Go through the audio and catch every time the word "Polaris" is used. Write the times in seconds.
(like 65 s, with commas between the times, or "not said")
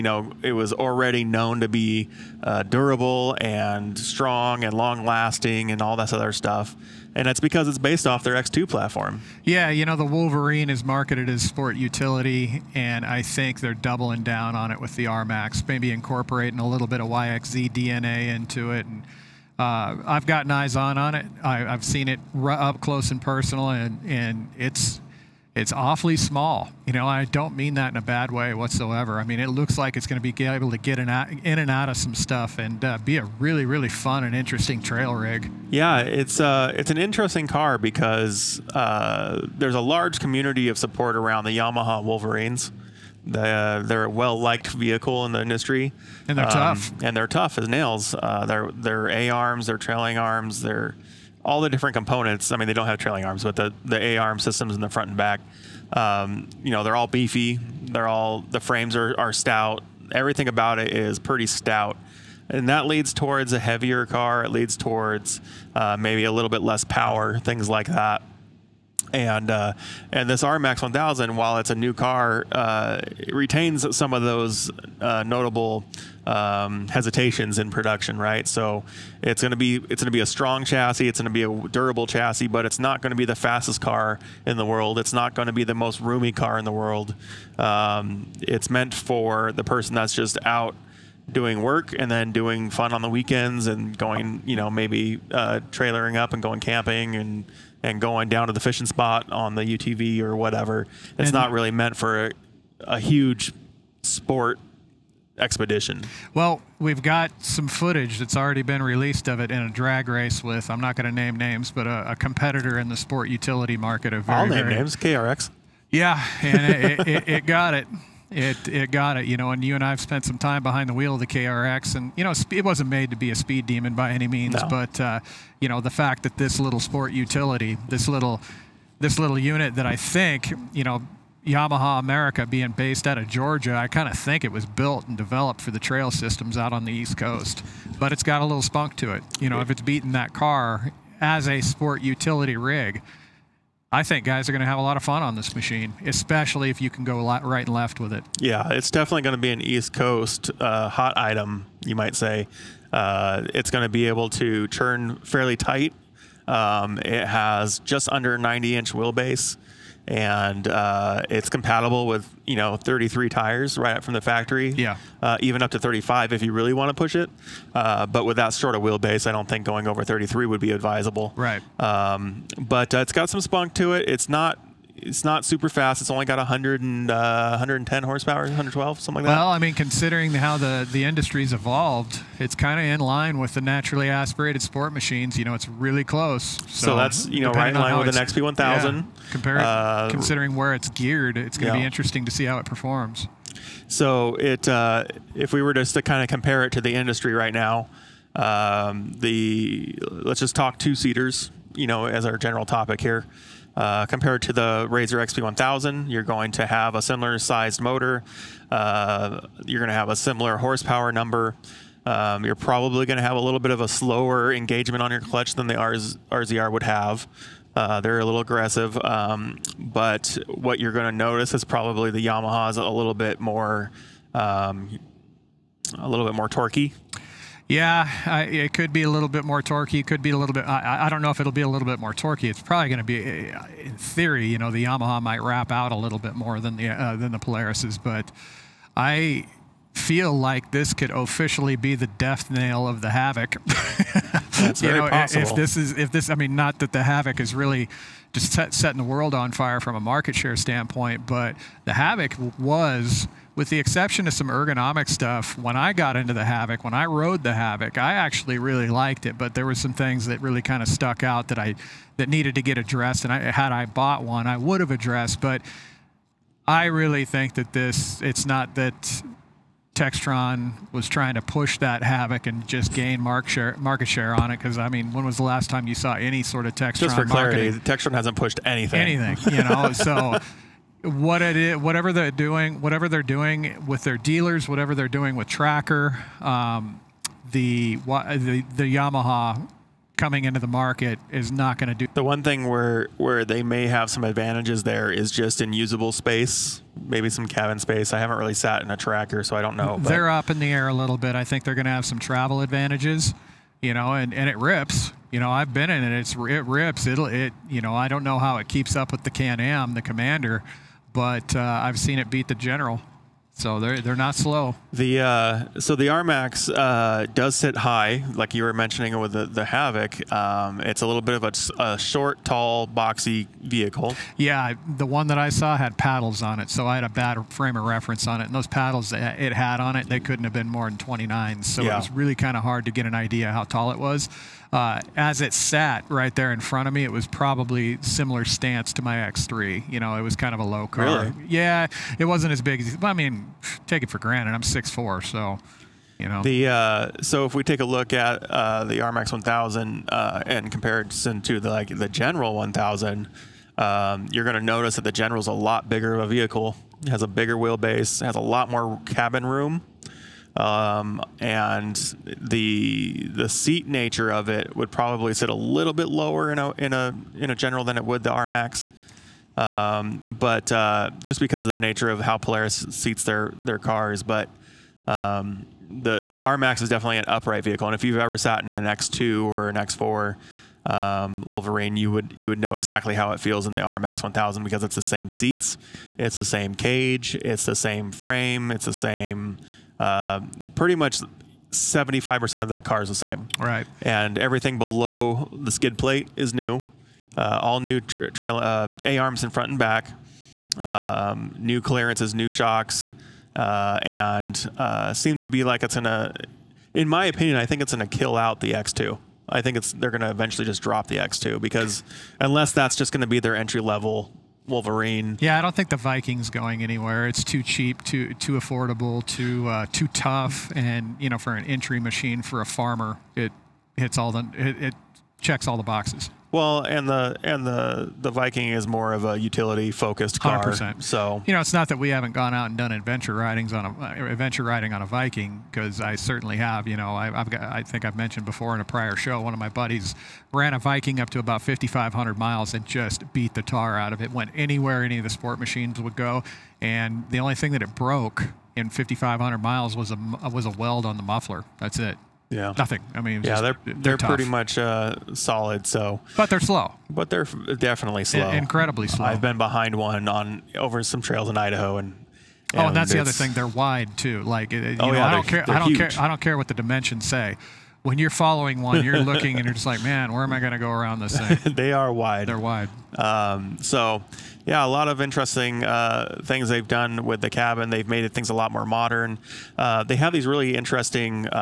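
237 s, 372 s.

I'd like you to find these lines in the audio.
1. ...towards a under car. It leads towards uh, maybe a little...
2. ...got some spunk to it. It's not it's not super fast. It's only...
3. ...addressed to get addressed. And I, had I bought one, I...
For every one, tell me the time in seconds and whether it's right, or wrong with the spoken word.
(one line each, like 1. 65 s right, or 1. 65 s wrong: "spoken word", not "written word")
1. 63 s wrong: "heavier", not "under"
2. 173 s right
3. 262 s wrong: "needed", not "addressed".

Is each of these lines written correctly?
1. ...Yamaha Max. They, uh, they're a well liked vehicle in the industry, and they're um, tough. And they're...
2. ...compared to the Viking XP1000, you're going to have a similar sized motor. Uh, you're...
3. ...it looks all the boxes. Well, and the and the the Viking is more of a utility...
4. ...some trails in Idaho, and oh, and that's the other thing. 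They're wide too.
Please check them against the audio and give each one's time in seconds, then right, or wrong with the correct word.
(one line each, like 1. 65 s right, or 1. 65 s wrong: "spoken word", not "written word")
1. 41 s wrong: "Wolverines", not "Max"
2. 204 s wrong: "RZR", not "Viking"
3. 424 s wrong: "checks", not "looks"
4. 461 s right.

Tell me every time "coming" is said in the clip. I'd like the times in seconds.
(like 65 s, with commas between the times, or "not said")
290 s.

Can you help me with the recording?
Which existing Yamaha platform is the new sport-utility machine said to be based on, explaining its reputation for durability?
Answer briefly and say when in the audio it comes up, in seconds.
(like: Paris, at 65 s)
X2, at 8 s.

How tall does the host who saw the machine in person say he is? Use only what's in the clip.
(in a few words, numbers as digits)
6'4".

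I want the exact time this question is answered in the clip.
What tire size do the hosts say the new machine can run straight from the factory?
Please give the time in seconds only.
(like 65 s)
162 s.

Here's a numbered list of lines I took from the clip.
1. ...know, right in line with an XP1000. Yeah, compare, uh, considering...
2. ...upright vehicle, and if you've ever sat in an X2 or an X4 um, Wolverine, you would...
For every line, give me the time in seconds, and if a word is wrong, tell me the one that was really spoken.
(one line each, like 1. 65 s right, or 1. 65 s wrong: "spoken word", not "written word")
1. 187 s right
2. 377 s right.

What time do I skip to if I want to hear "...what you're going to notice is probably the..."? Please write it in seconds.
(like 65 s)
220 s.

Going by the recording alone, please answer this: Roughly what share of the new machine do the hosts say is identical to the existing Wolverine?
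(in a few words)
75%.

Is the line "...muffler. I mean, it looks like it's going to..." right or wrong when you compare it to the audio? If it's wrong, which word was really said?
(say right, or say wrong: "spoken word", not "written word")
wrong: "whatsoever", not "muffler".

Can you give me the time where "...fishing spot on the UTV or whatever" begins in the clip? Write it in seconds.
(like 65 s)
98 s.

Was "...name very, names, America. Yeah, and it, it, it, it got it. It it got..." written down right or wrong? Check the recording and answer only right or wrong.
wrong.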